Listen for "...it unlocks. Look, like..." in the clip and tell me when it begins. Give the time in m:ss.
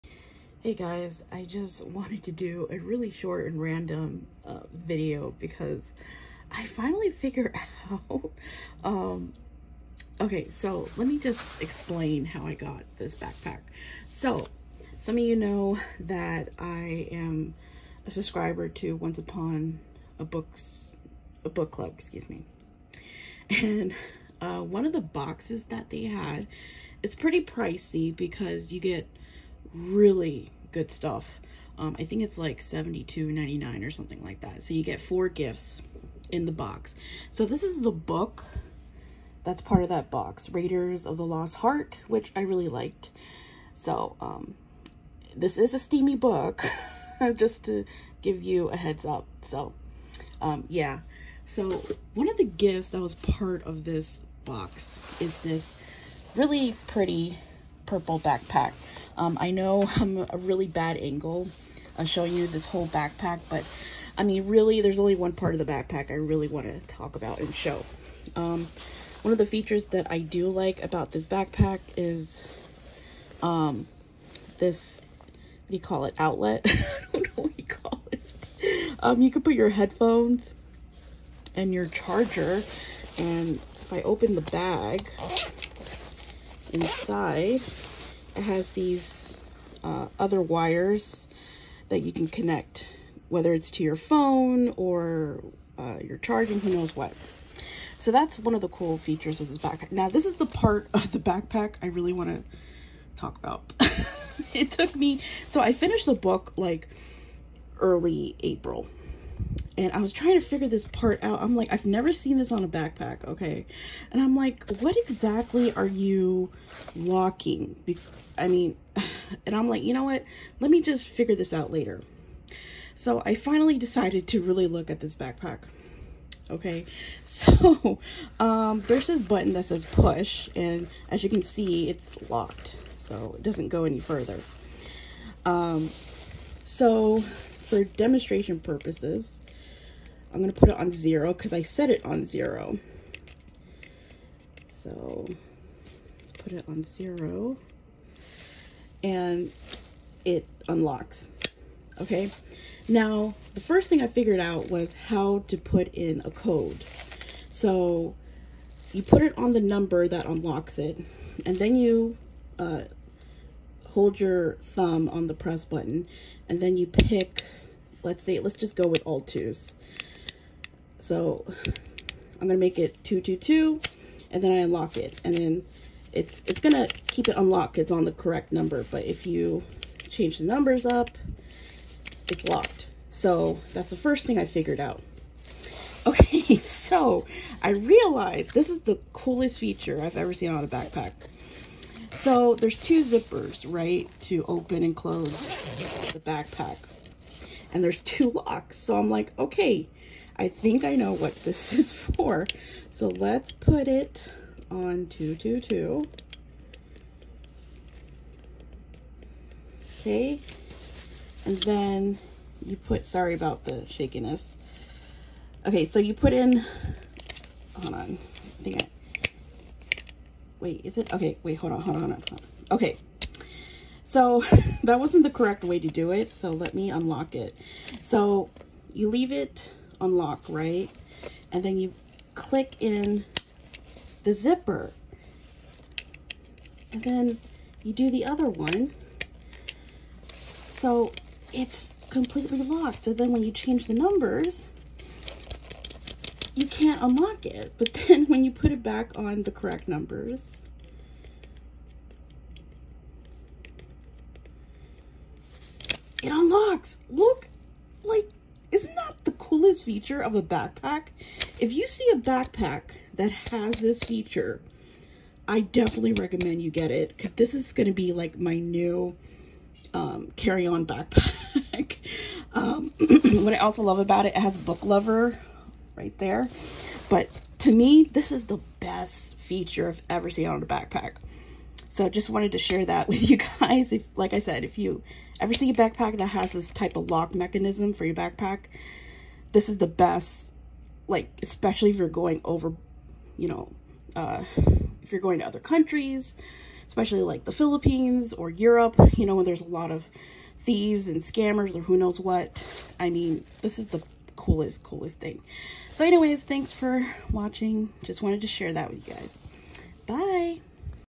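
4:16.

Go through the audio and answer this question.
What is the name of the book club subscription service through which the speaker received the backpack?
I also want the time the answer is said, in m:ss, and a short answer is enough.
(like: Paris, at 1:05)
Once Upon a Books, at 0:18.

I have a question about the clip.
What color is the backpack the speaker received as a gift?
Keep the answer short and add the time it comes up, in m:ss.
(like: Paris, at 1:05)
Purple, at 0:57.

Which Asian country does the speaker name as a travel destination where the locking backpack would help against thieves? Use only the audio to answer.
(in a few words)
The Philippines.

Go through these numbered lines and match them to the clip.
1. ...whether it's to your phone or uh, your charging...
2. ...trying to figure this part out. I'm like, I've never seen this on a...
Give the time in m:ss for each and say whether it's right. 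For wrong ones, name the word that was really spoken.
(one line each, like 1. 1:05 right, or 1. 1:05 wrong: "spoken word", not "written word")
1. 1:33 right
2. 1:50 right.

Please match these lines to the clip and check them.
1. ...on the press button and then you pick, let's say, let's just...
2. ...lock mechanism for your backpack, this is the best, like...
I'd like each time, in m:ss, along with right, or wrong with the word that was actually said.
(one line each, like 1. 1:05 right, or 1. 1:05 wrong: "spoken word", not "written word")
1. 2:45 right
2. 4:47 right.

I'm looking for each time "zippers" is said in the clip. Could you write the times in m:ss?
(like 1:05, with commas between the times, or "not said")
3:13, 3:54.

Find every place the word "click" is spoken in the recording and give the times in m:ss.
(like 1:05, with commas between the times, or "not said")
3:52.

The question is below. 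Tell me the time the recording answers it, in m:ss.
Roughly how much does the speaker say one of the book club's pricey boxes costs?
0:32.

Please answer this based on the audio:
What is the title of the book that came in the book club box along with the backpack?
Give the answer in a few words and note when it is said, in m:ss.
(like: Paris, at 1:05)
Raiders of the Lost Heart, at 0:40.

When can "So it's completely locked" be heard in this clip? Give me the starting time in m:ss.
4:00.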